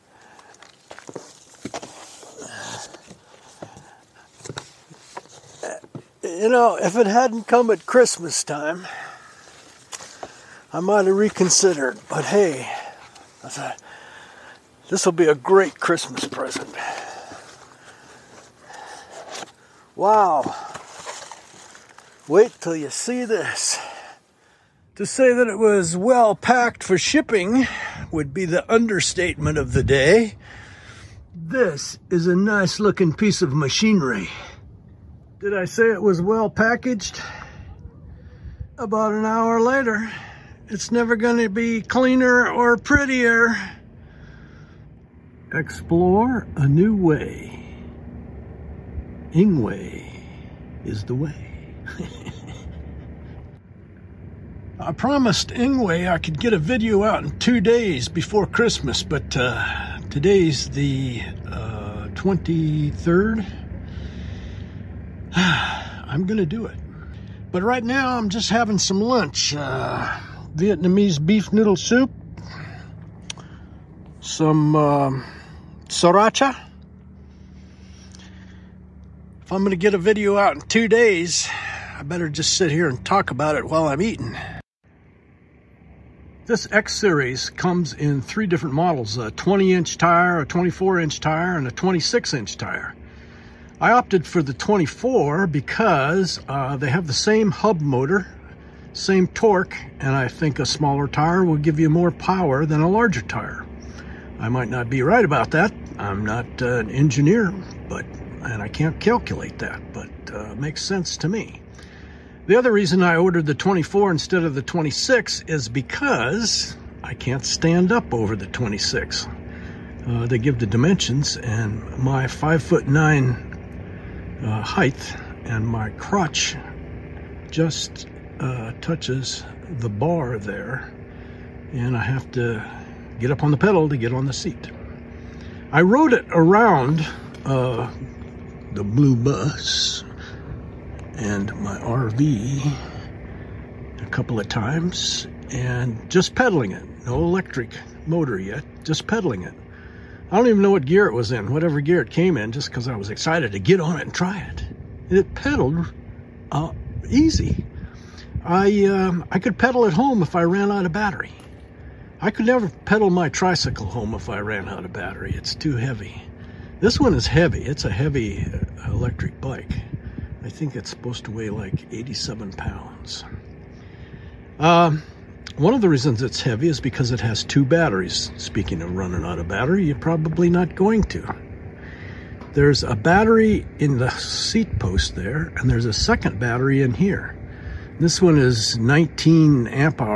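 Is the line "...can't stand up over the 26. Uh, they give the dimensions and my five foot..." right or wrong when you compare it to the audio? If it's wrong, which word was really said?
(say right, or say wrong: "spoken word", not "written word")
right.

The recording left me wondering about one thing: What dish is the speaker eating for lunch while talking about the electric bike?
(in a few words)
Vietnamese beef noodle soup.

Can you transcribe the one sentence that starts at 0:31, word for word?
This is a nice looking piece of machinery.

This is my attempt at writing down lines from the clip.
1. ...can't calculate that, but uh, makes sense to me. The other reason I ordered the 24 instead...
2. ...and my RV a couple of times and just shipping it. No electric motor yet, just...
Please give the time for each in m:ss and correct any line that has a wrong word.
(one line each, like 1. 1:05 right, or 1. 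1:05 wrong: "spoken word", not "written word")
1. 1:48 right
2. 2:21 wrong: "pedaling", not "shipping".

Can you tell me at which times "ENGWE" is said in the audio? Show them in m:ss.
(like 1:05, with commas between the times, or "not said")
0:49, 0:55.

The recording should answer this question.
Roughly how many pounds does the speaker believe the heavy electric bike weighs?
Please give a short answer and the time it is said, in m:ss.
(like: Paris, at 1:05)
87, at 2:51.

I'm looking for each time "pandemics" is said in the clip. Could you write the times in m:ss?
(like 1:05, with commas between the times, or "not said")
not said.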